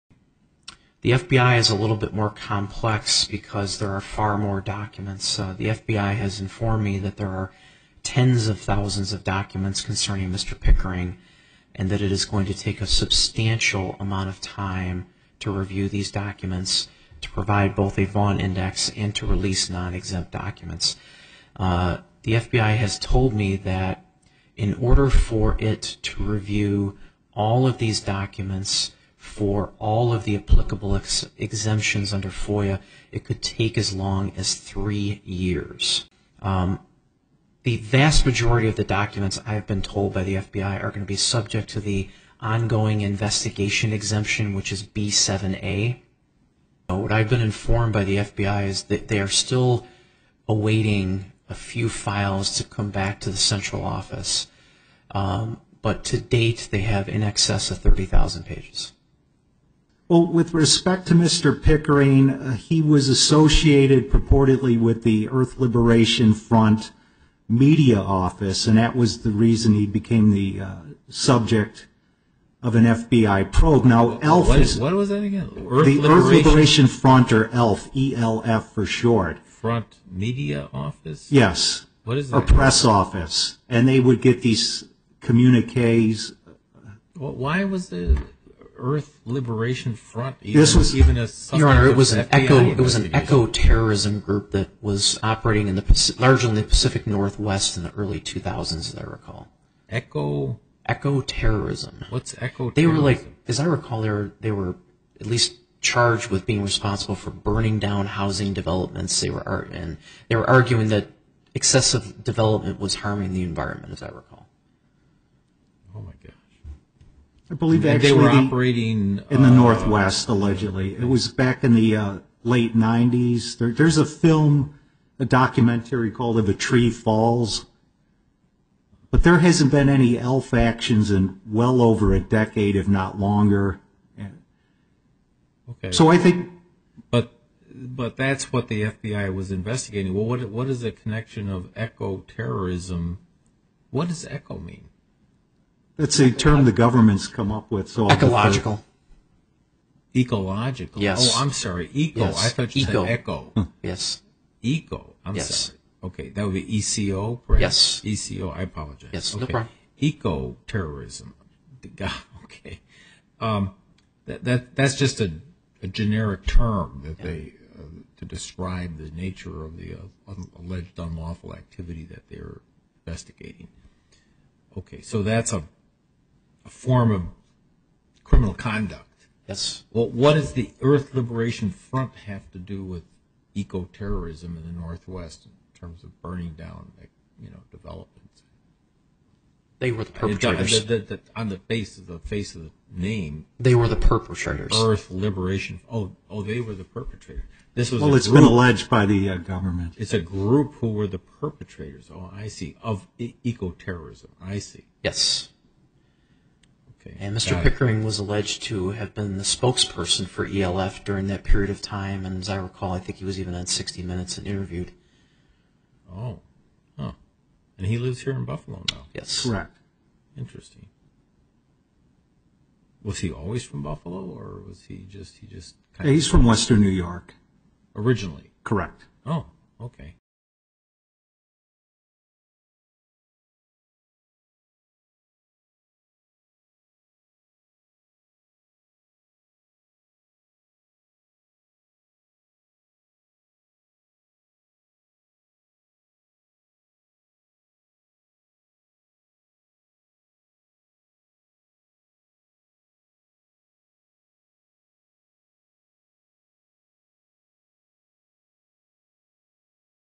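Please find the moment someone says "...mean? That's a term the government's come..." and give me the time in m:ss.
2:24.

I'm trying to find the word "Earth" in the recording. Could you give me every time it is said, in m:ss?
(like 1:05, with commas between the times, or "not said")
1:05, 1:15, 1:28, 3:00, 3:14.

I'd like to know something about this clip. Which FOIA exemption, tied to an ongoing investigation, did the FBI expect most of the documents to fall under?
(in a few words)
b7a.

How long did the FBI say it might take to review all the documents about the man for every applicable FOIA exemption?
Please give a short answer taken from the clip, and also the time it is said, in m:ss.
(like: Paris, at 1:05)
3 years, at 0:34.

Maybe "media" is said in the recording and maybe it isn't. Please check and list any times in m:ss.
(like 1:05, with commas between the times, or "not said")
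1:07, 1:20.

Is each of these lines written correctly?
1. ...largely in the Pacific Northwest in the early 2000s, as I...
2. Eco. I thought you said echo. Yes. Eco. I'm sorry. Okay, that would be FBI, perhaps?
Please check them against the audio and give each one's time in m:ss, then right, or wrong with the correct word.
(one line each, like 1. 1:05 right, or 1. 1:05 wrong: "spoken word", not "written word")
1. 1:36 right
2. 2:31 wrong: "ECO", not "FBI".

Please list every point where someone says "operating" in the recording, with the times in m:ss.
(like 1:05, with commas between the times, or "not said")
1:35, 1:58.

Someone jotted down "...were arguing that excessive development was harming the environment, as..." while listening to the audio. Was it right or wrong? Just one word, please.
right.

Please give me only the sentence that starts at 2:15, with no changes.
Okay, So I think but, but that's what the FBI was investigating.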